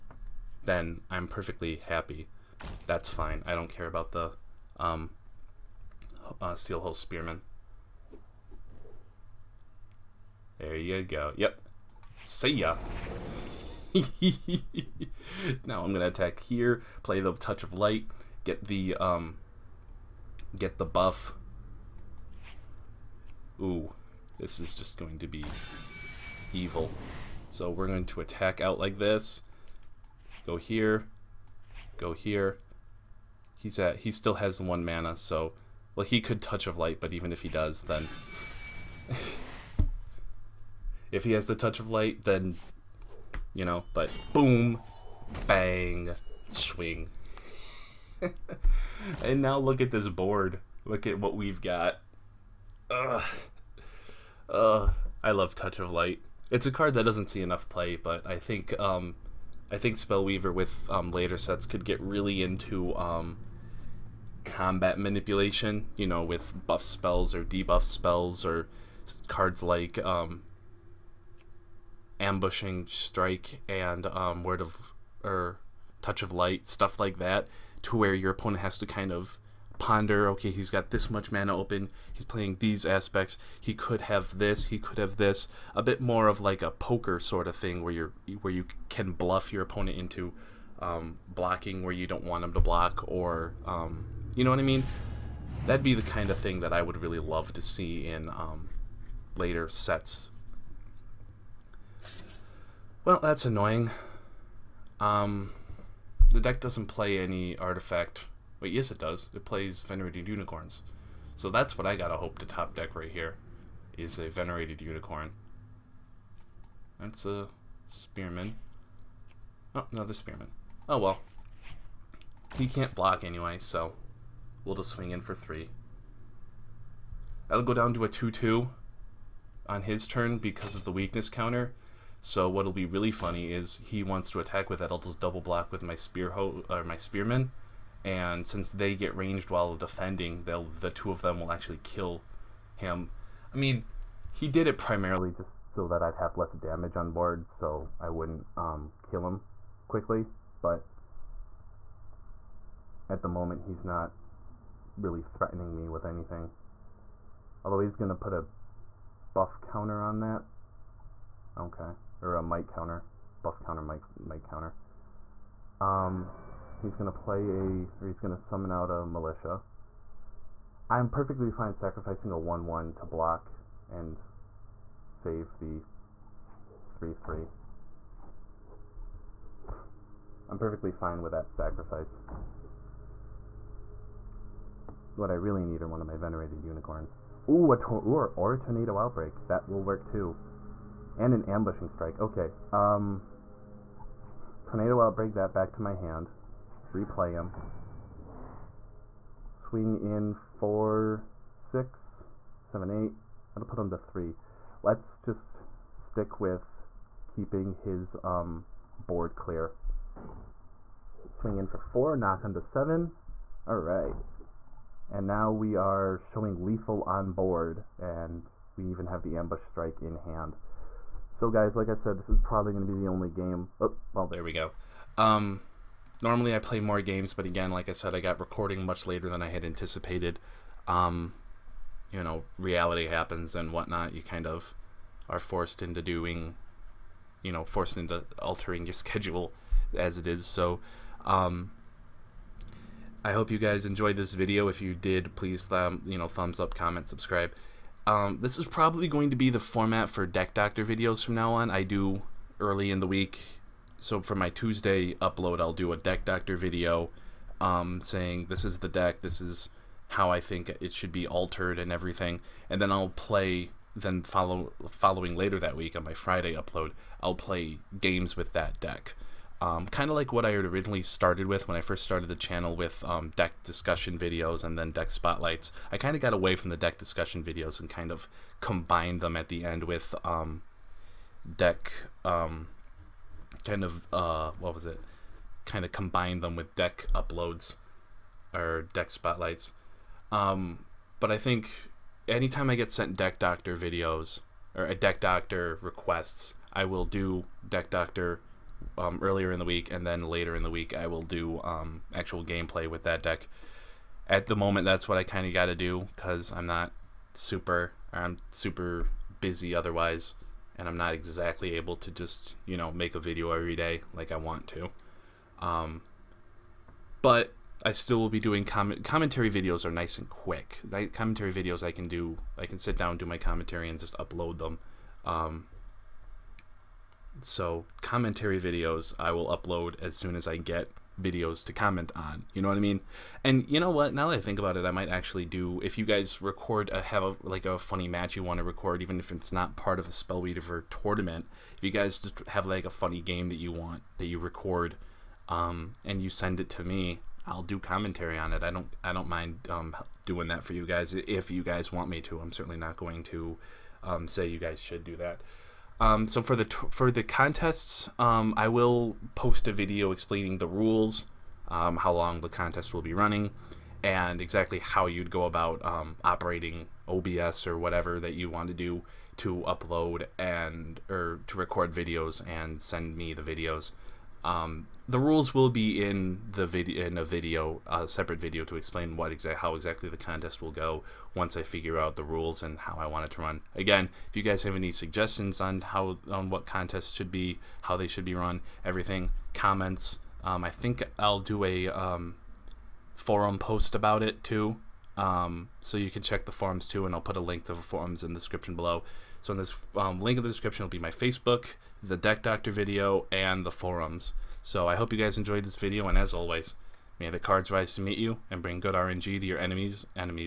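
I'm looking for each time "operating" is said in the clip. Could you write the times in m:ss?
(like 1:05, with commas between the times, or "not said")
6:06.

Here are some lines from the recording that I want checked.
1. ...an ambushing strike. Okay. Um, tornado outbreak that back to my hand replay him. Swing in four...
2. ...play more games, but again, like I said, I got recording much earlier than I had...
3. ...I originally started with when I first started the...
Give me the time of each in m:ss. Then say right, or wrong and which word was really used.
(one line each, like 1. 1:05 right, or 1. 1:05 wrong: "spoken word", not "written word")
1. 3:11 right
2. 3:46 wrong: "later", not "earlier"
3. 4:30 right.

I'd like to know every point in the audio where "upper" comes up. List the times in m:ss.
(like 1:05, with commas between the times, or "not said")
not said.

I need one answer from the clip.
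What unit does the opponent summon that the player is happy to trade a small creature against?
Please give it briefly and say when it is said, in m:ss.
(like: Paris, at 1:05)
Militia, at 2:49.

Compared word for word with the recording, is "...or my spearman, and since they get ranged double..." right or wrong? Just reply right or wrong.
wrong.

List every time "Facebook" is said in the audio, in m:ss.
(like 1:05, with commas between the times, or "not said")
6:41.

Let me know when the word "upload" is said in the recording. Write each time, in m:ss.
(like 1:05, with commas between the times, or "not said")
4:15, 4:26, 4:47, 5:24, 5:29, 6:09.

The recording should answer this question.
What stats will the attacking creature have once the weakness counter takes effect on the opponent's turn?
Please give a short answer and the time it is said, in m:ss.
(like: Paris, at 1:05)
2-2, at 2:08.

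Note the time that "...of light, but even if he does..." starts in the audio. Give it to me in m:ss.
0:36.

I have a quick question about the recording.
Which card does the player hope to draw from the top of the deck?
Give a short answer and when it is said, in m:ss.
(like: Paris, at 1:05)
Venerated Unicorn, at 1:54.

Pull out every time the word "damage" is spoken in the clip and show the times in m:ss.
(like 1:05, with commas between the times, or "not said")
2:26.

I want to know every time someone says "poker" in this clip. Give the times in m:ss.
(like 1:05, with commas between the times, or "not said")
1:26.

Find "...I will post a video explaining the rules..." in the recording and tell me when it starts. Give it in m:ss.
5:58.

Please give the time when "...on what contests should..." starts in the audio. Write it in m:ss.
6:26.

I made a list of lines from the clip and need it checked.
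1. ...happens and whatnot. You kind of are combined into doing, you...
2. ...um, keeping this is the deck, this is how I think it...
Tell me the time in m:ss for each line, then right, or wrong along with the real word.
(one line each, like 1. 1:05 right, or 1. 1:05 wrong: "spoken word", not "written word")
1. 3:53 wrong: "forced", not "combined"
2. 4:17 wrong: "saying", not "keeping".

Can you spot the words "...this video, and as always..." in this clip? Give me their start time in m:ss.
6:45.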